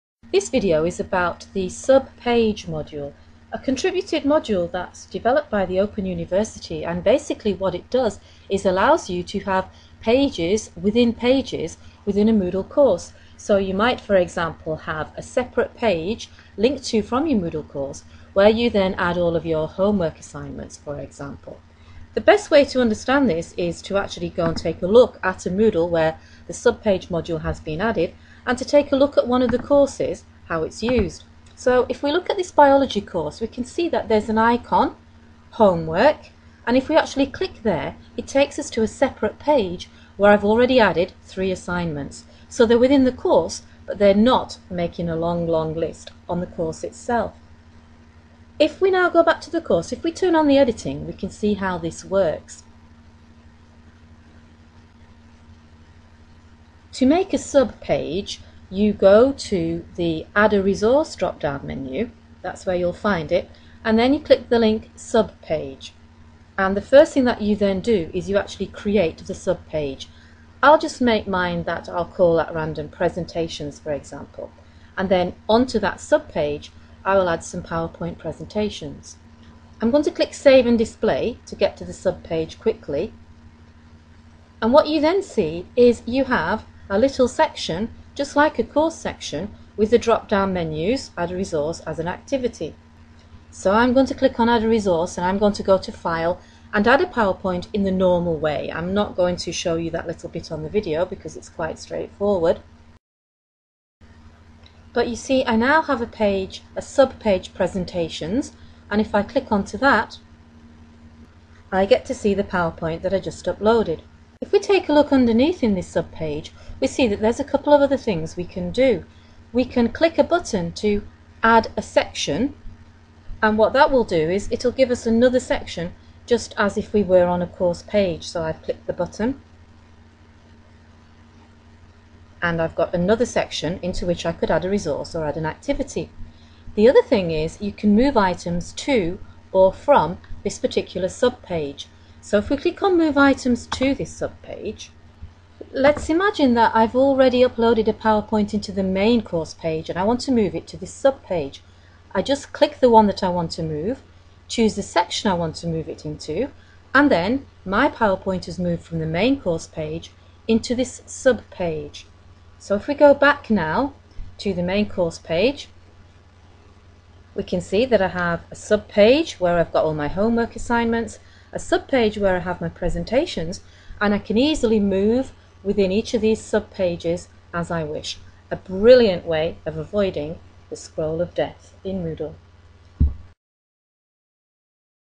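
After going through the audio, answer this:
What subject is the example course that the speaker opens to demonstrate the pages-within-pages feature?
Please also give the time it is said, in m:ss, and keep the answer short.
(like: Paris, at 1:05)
Biology, at 0:32.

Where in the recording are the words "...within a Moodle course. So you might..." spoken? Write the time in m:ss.
0:12.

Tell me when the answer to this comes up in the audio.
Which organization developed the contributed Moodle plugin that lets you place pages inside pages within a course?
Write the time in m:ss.
0:05.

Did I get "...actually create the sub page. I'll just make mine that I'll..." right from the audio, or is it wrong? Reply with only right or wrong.
right.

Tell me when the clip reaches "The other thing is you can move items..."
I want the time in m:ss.
2:16.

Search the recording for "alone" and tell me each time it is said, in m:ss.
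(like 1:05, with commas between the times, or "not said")
not said.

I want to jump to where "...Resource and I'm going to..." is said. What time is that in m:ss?
1:34.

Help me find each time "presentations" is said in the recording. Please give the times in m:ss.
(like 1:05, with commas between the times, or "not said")
1:12, 1:18, 1:47, 2:52.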